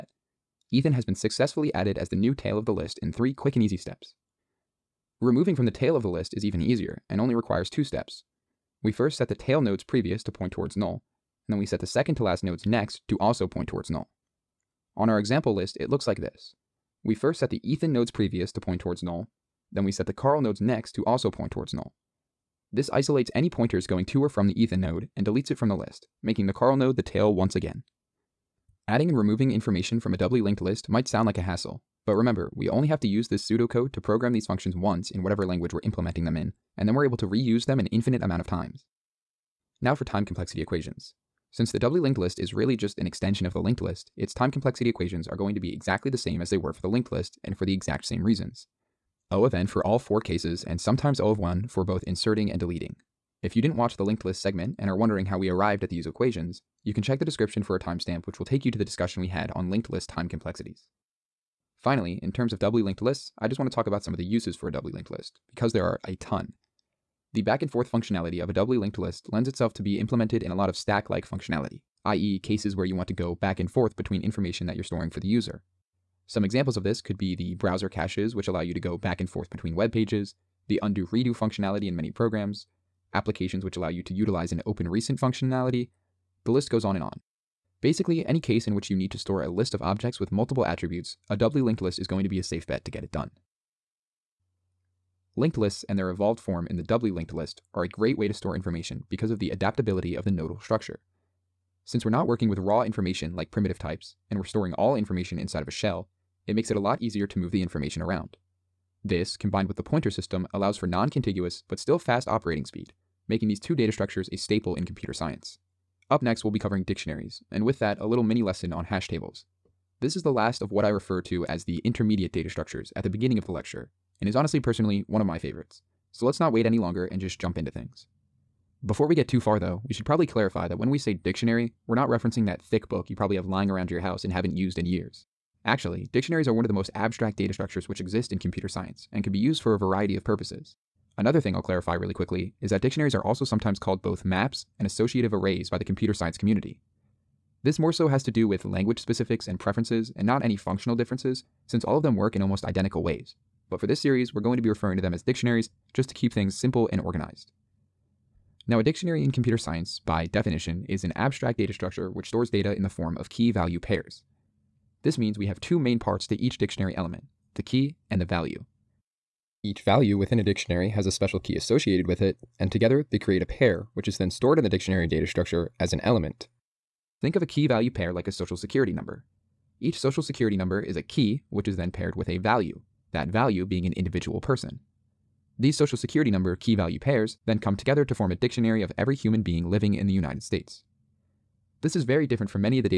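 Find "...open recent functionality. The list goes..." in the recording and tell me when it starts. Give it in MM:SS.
01:24.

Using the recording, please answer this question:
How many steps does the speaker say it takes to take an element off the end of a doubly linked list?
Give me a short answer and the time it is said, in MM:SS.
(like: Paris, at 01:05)
2, at 00:07.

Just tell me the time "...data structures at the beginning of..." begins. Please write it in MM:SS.
02:02.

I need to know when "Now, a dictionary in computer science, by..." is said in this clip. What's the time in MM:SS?
02:38.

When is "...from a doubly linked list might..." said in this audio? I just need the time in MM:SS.
00:29.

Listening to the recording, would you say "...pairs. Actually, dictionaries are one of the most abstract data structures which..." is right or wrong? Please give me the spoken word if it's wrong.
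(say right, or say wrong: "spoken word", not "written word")
wrong: "years", not "pairs".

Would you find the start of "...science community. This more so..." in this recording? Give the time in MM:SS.
02:26.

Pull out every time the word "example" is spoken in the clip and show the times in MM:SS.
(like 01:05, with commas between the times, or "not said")
00:15, 01:16.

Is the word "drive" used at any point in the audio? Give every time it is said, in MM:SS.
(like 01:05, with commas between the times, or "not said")
not said.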